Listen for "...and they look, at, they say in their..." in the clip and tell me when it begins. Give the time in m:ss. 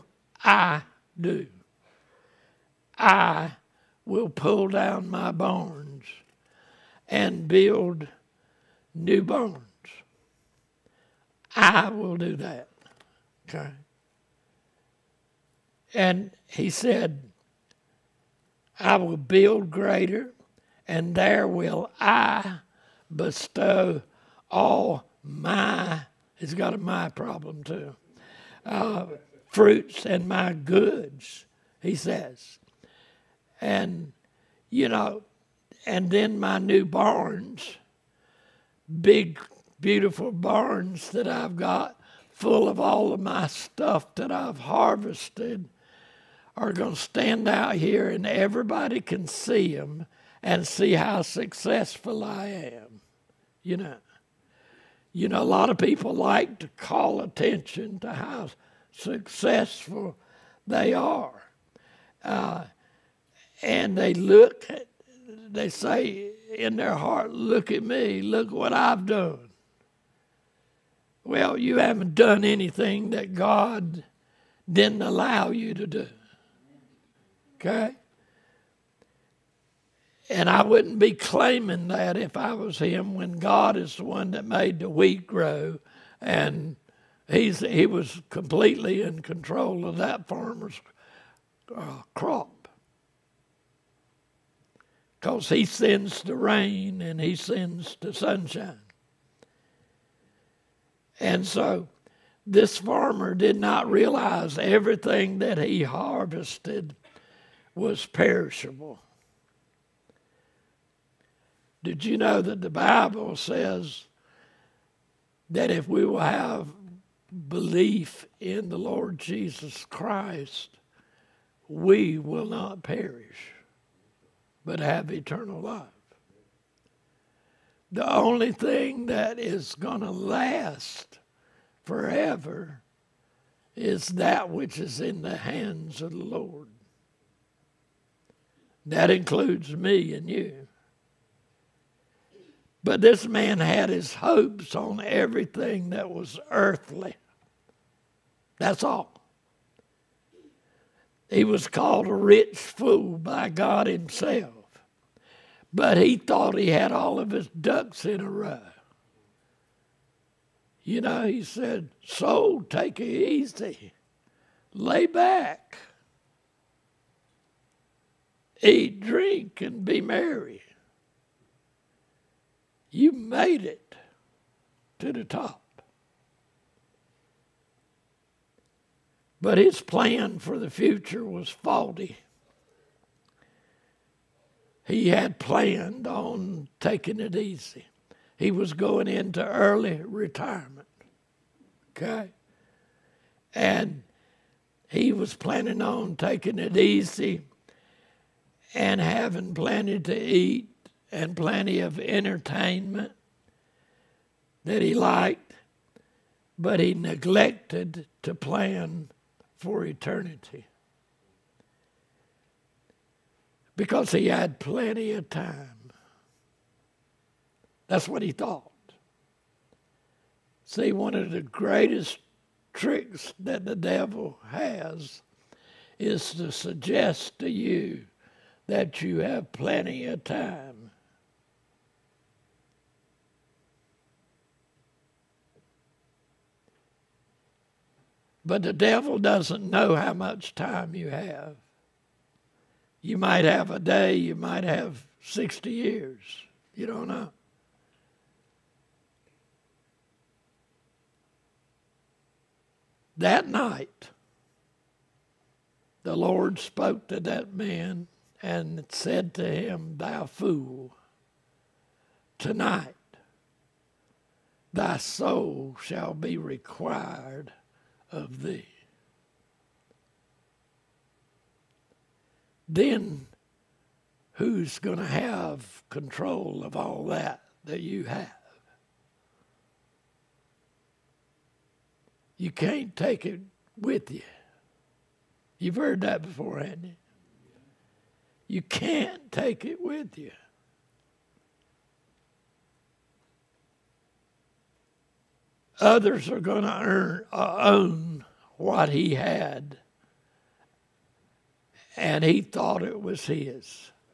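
1:03.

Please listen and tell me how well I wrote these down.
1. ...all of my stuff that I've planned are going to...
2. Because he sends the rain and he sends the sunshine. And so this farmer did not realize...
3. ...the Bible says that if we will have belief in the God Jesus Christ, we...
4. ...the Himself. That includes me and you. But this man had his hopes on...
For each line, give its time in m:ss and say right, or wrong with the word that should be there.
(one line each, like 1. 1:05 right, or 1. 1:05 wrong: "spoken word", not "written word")
1. 0:42 wrong: "harvested", not "planned"
2. 1:35 right
3. 1:52 wrong: "Lord", not "God"
4. 2:16 wrong: "Lord", not "Himself".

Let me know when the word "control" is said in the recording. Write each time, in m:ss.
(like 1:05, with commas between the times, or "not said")
1:29, 4:35.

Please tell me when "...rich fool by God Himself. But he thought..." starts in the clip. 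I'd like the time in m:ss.
2:32.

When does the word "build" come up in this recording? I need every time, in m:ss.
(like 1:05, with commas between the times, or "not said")
0:07, 0:19.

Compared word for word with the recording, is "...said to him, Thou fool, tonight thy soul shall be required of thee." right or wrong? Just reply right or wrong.
right.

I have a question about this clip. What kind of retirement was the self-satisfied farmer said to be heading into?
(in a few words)
Early retirement.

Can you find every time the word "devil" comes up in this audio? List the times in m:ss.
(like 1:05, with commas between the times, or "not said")
3:43, 3:58.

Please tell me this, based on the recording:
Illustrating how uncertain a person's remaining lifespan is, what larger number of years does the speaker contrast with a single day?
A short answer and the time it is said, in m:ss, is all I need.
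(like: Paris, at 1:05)
60 years, at 4:05.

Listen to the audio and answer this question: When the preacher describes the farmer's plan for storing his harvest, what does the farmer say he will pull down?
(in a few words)
My barns.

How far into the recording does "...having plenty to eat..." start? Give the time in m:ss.
3:19.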